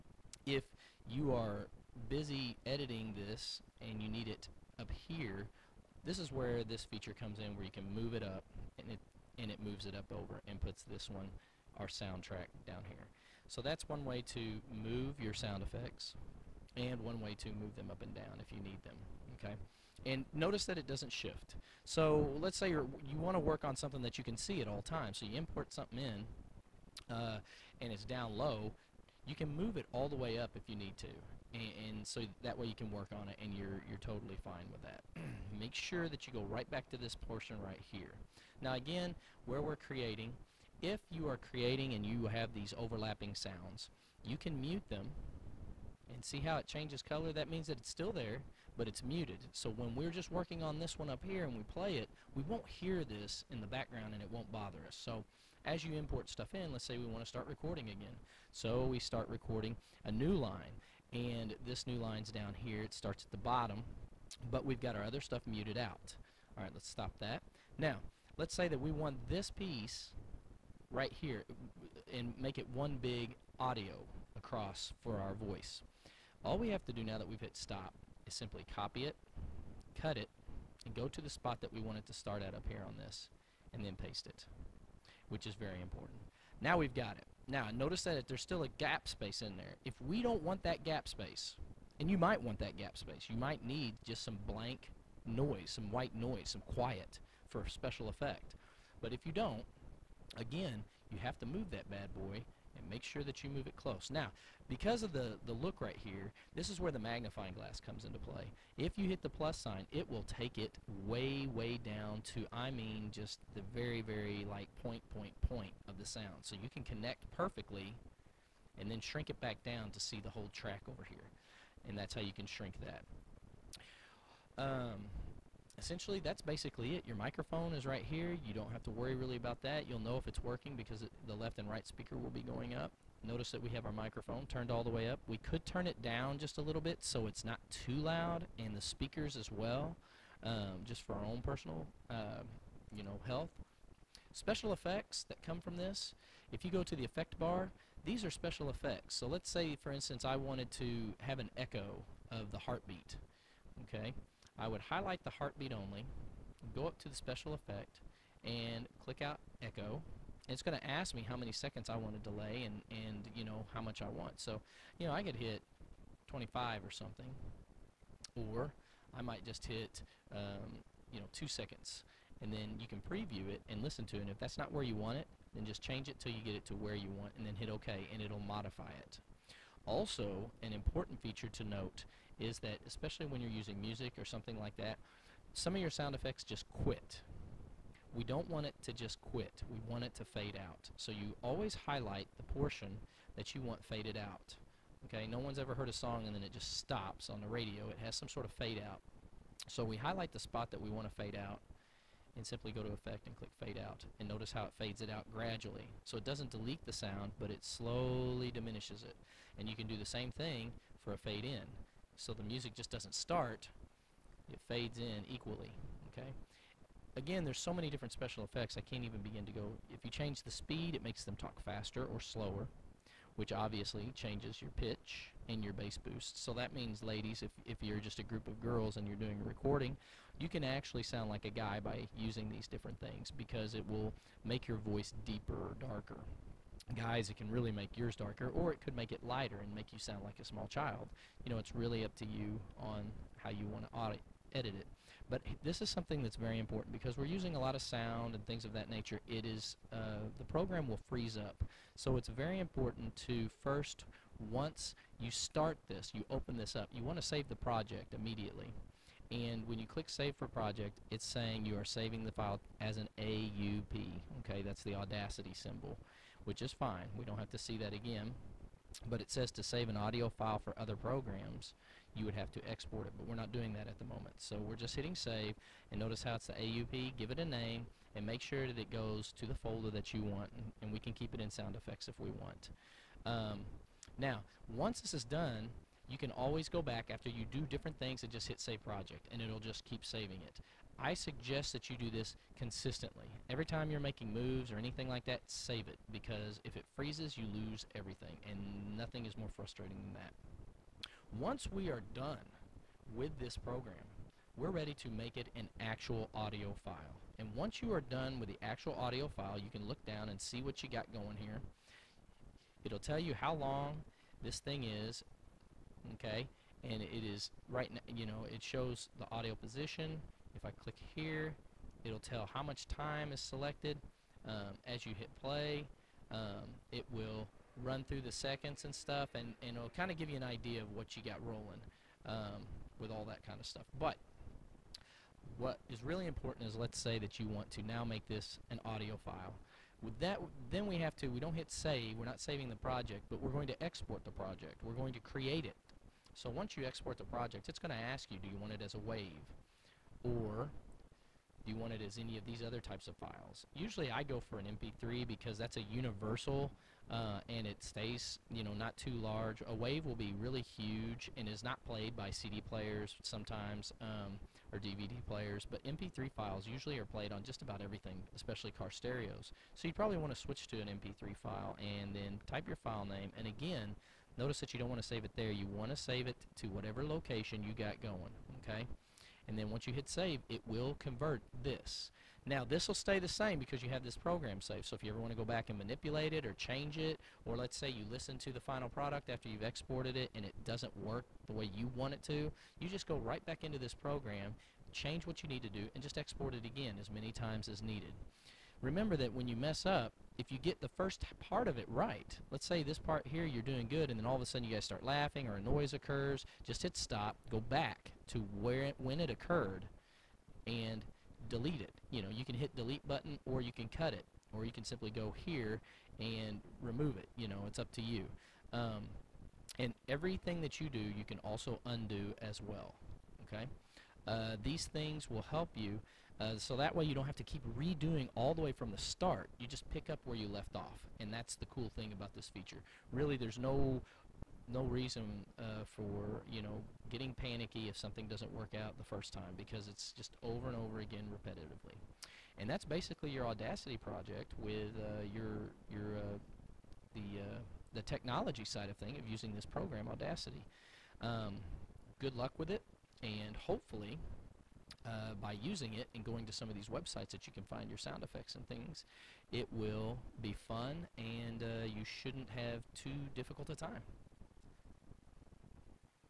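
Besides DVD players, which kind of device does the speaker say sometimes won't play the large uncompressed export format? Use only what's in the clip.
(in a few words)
CD players.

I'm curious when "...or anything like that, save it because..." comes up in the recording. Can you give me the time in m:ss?
4:54.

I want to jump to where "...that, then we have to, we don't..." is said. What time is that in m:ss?
5:40.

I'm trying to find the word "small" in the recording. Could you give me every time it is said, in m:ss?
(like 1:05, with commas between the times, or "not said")
4:00.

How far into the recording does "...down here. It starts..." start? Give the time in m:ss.
1:02.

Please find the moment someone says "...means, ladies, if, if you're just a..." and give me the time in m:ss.
3:46.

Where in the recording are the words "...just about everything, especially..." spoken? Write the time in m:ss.
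6:07.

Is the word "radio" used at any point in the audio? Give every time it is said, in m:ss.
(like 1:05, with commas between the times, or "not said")
3:17.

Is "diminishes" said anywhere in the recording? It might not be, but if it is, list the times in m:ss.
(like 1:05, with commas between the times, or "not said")
3:28.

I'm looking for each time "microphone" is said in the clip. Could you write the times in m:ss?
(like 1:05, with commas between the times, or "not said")
2:07, 2:13.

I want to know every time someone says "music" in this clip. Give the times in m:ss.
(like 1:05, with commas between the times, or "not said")
3:03, 3:32.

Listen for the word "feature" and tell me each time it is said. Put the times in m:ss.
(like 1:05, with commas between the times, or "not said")
0:06, 3:01, 7:12.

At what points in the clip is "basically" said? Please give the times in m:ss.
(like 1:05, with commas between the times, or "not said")
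2:06, 7:22.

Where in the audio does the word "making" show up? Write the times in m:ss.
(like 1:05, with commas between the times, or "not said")
4:54.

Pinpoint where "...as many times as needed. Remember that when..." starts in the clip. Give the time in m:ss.
6:37.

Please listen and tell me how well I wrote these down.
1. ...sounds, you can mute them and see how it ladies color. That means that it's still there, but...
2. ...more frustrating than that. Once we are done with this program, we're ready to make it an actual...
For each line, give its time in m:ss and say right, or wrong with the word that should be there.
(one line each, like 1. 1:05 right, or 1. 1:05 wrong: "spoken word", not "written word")
1. 0:43 wrong: "changes", not "ladies"
2. 4:59 right.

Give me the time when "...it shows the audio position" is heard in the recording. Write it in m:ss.
5:18.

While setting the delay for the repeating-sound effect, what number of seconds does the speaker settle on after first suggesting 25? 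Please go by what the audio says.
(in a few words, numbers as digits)
2 seconds.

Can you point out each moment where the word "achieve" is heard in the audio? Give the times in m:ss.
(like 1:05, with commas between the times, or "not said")
not said.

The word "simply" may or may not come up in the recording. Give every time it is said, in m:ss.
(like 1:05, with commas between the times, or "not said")
1:18, 3:22, 6:54.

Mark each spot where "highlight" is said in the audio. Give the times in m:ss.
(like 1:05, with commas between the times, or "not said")
2:34, 3:11, 3:19.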